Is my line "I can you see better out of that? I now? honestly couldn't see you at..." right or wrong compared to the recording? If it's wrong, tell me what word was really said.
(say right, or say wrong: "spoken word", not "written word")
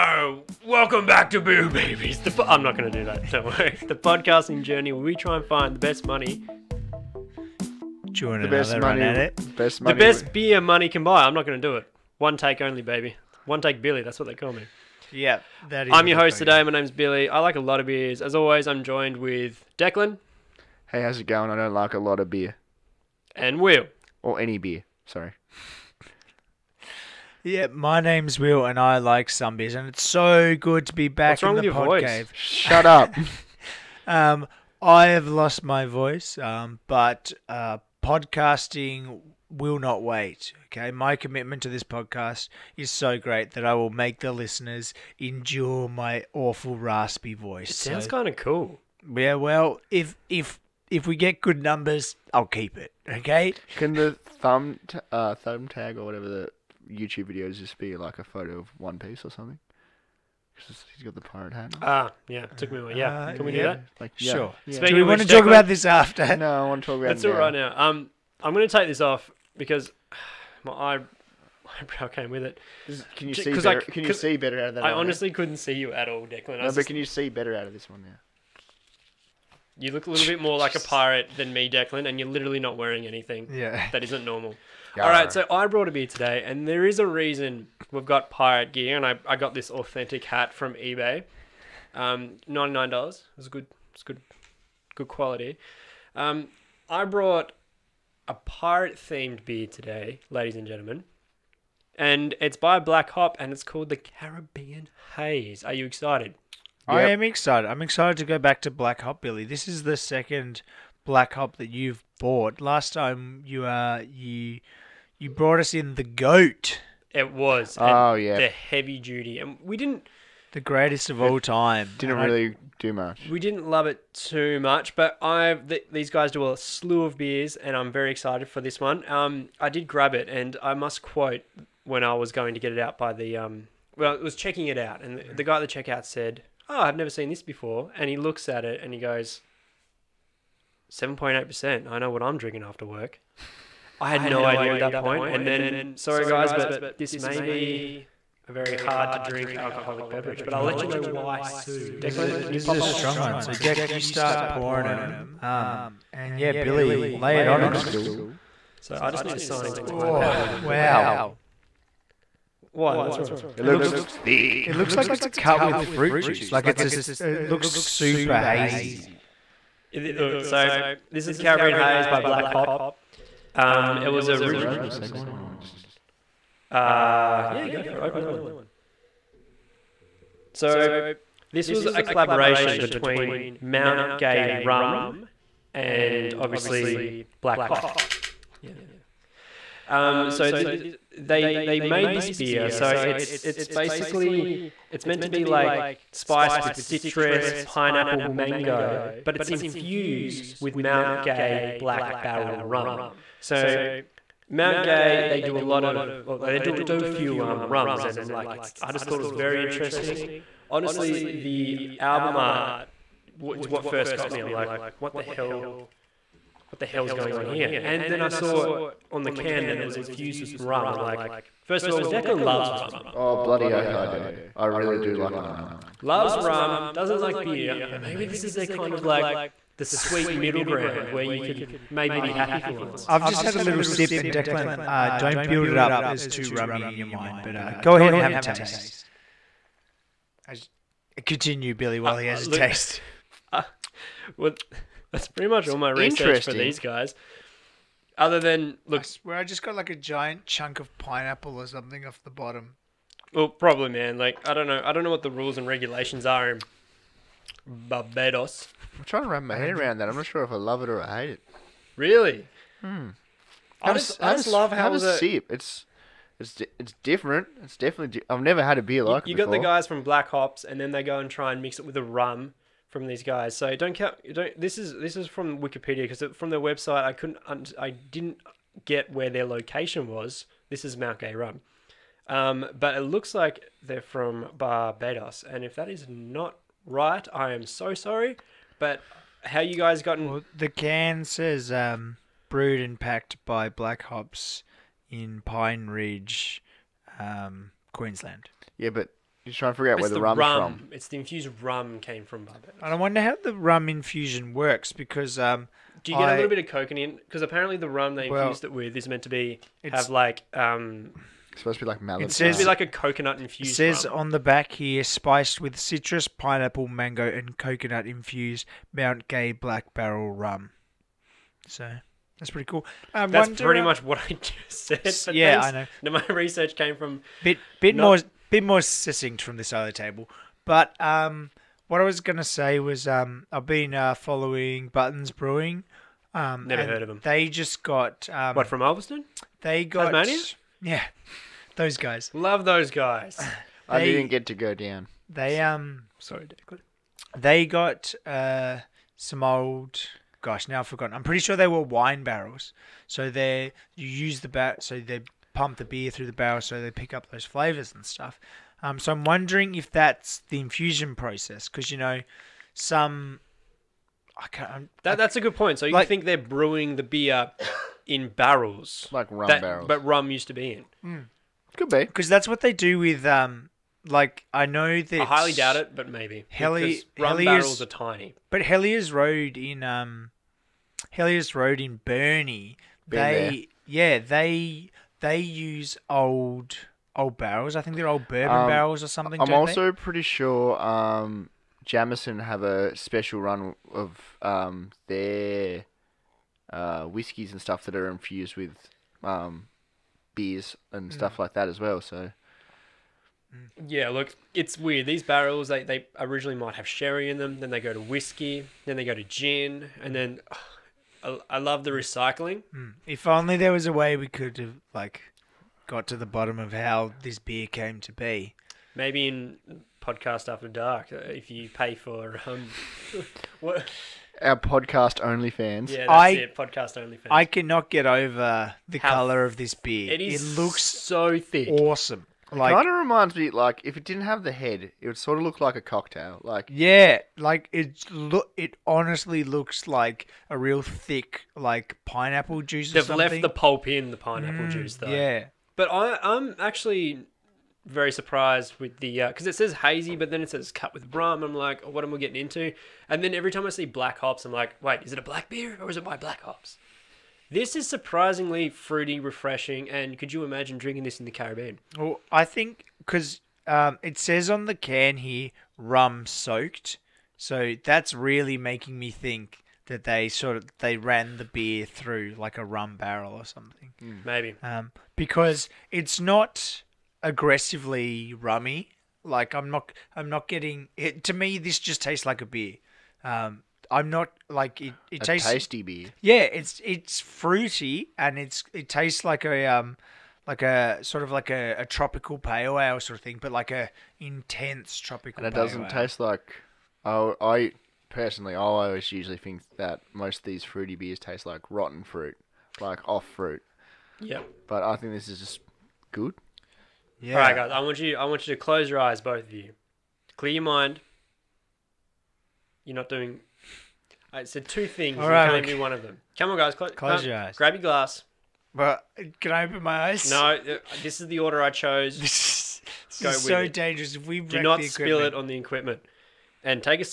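right.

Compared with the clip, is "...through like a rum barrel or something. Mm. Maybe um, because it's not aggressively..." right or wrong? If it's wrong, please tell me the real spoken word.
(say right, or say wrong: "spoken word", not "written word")
right.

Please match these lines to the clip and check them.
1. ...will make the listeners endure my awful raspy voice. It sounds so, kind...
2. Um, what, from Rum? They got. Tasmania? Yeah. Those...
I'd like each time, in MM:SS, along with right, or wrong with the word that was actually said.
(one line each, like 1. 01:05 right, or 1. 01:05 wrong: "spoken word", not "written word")
1. 00:43 right
2. 05:38 wrong: "Ulverstone", not "Rum".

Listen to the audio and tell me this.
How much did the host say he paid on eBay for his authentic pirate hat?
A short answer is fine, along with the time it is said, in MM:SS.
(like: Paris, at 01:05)
$99, at 01:32.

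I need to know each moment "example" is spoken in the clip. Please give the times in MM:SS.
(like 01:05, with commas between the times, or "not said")
not said.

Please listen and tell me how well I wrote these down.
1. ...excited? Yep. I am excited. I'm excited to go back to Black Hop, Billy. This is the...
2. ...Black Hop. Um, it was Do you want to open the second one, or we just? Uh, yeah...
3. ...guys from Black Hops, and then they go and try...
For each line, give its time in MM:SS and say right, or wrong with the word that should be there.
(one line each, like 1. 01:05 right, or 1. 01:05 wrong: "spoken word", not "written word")
1. 01:45 right
2. 02:52 right
3. 04:29 right.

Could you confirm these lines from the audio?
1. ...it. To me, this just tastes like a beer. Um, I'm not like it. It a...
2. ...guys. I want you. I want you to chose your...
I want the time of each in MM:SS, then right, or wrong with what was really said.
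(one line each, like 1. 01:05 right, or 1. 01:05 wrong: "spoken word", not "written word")
1. 08:00 right
2. 08:27 wrong: "close", not "chose".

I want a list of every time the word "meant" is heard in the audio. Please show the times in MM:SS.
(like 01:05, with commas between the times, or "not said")
03:15, 05:09.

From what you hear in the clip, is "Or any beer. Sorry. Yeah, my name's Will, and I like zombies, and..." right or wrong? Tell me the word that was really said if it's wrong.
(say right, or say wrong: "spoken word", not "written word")
right.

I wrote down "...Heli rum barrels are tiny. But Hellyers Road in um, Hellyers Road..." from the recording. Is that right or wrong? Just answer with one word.
right.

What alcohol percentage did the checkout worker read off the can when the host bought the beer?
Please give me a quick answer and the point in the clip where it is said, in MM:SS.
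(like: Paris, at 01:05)
7.8%, at 02:20.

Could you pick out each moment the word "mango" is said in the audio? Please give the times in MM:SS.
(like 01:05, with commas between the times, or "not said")
03:18, 05:16.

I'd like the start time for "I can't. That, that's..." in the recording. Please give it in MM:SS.
06:04.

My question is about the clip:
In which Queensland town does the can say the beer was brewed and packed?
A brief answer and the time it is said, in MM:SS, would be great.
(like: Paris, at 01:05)
Pine Ridge, at 04:55.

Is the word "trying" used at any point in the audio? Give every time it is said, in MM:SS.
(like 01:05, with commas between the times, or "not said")
04:19, 04:59.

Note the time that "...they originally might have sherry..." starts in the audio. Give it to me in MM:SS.
06:45.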